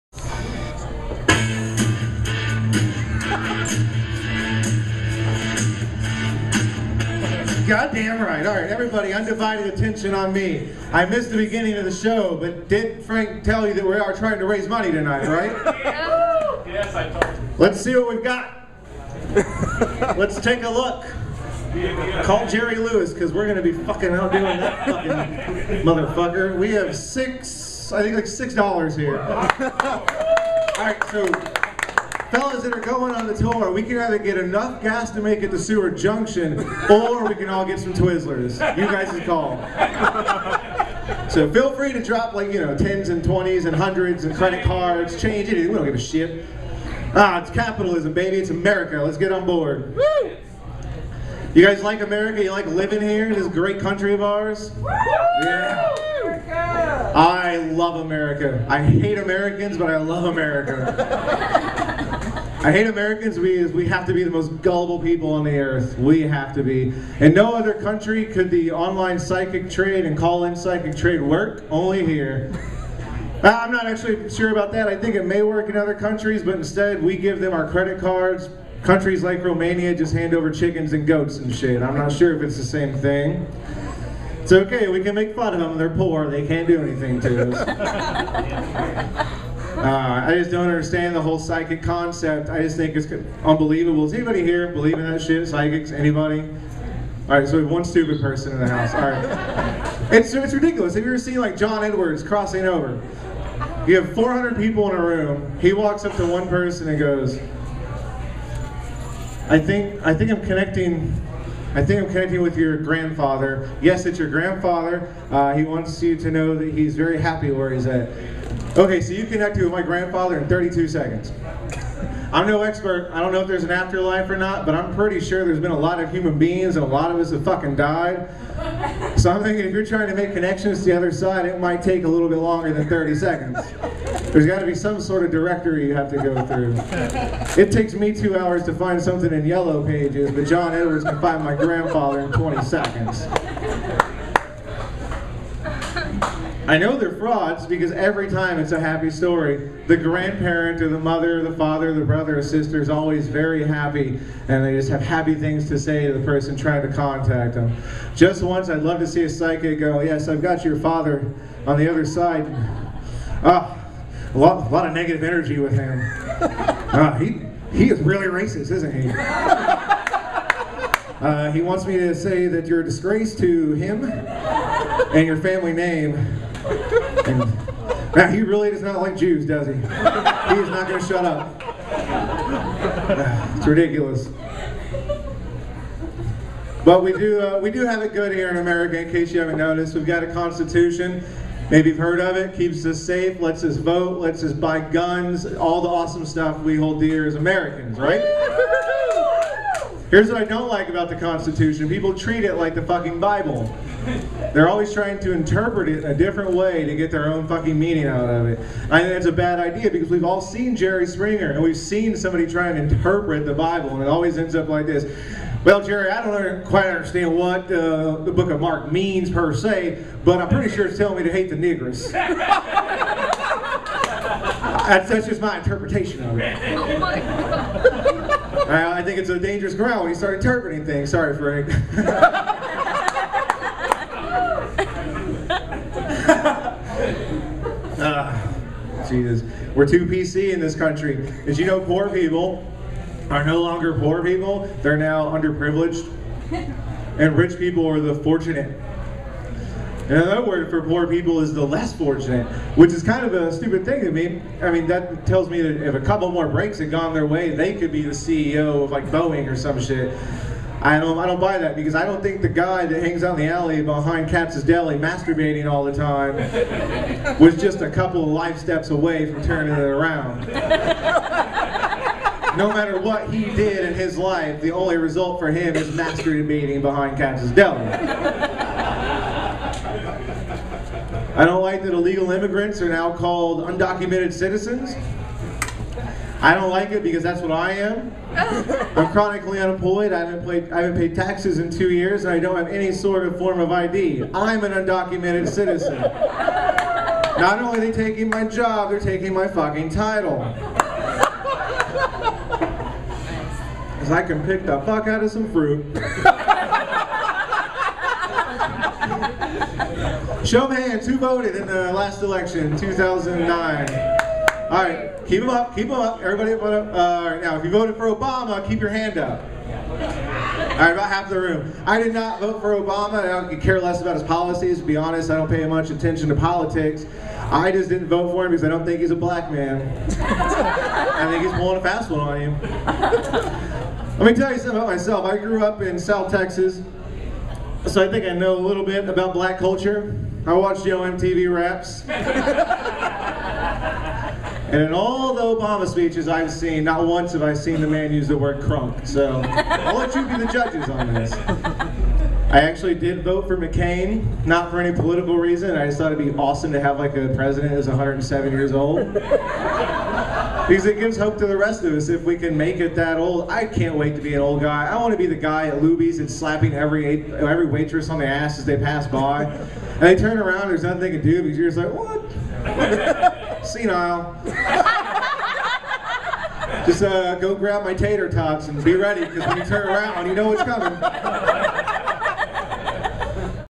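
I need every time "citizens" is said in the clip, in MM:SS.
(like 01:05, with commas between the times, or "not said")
04:44, 04:55.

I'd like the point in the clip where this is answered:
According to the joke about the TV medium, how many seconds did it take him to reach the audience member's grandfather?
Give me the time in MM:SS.
02:00.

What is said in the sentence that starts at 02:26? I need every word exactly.
I know they're frauds because every time it's a happy story.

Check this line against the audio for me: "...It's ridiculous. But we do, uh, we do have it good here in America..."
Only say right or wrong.
right.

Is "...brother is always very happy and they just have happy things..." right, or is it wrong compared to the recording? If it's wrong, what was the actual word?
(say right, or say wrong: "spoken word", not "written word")
wrong: "sister", not "brother".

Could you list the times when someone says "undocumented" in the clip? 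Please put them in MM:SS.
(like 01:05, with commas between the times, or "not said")
04:43, 04:54.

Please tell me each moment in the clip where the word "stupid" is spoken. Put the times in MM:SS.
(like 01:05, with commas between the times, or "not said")
01:37, 04:13.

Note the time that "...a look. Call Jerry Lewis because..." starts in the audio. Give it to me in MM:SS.
00:20.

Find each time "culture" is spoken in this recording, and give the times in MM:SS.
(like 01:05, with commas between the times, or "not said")
05:39.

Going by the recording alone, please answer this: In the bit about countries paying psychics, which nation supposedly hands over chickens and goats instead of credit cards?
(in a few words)
Romania.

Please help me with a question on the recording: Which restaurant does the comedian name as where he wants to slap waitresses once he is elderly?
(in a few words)
Luby's.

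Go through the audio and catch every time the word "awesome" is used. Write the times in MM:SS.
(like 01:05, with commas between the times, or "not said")
03:15, 05:56.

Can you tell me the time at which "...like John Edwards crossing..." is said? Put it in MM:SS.
01:41.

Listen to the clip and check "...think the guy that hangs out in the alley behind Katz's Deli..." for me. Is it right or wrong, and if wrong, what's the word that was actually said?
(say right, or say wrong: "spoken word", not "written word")
right.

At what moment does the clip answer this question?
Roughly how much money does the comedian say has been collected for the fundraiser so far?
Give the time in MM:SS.
00:28.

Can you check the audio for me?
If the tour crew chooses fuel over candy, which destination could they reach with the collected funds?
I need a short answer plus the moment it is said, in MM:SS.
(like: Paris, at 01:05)
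Seward Junction, at 00:35.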